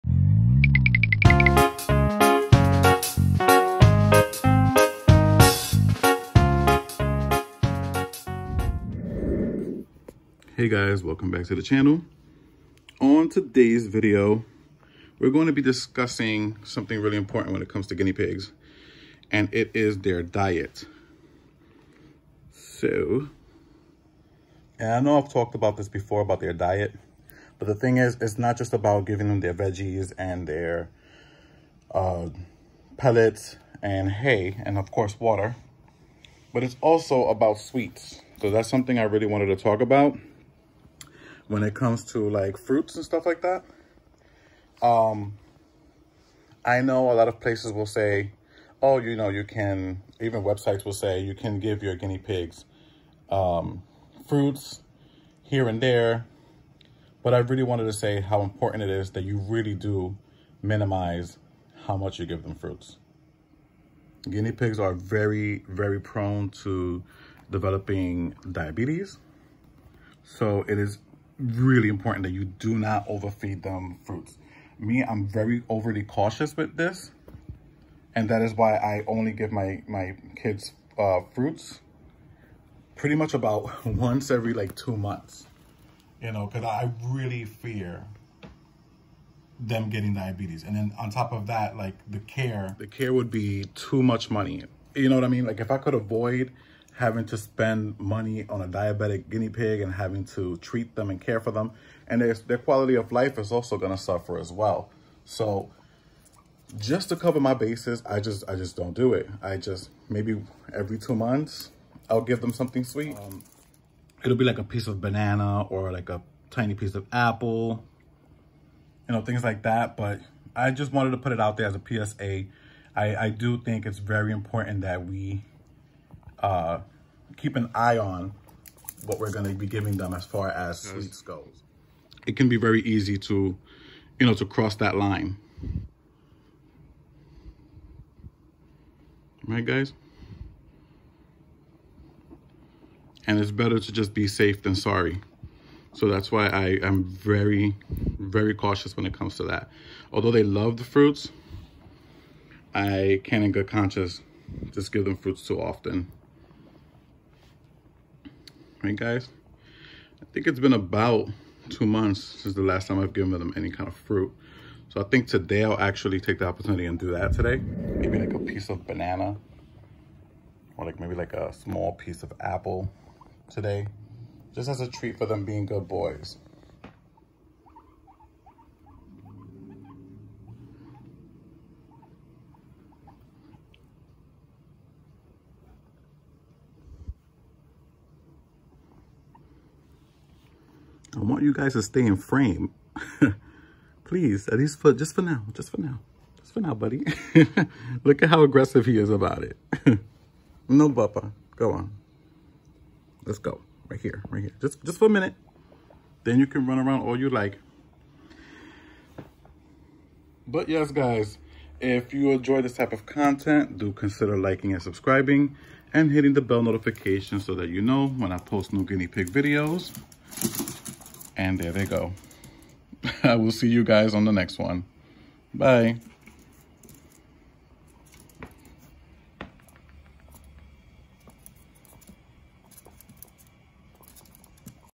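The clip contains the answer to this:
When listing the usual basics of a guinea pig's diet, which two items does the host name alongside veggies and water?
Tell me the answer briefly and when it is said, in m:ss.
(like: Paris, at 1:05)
pellets and hay, at 0:32.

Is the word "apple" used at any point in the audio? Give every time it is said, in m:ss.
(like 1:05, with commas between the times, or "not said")
1:57, 2:52.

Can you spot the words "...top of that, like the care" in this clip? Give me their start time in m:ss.
1:31.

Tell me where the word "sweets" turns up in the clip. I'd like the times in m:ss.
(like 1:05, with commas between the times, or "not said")
0:37, 1:52, 2:10.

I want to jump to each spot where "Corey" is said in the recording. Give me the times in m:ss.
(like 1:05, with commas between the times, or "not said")
not said.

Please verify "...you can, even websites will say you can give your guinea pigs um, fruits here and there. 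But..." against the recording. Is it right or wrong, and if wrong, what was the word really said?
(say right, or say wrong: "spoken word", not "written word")
right.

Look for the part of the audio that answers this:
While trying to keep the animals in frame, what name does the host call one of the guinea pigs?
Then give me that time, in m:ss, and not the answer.
3:20.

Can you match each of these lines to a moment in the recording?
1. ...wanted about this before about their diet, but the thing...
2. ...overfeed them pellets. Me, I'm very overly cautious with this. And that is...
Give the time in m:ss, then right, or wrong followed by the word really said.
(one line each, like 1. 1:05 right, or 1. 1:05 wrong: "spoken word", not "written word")
1. 0:25 wrong: "talked", not "wanted"
2. 1:13 wrong: "fruits", not "pellets".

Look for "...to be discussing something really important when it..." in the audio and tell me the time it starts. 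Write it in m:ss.
0:15.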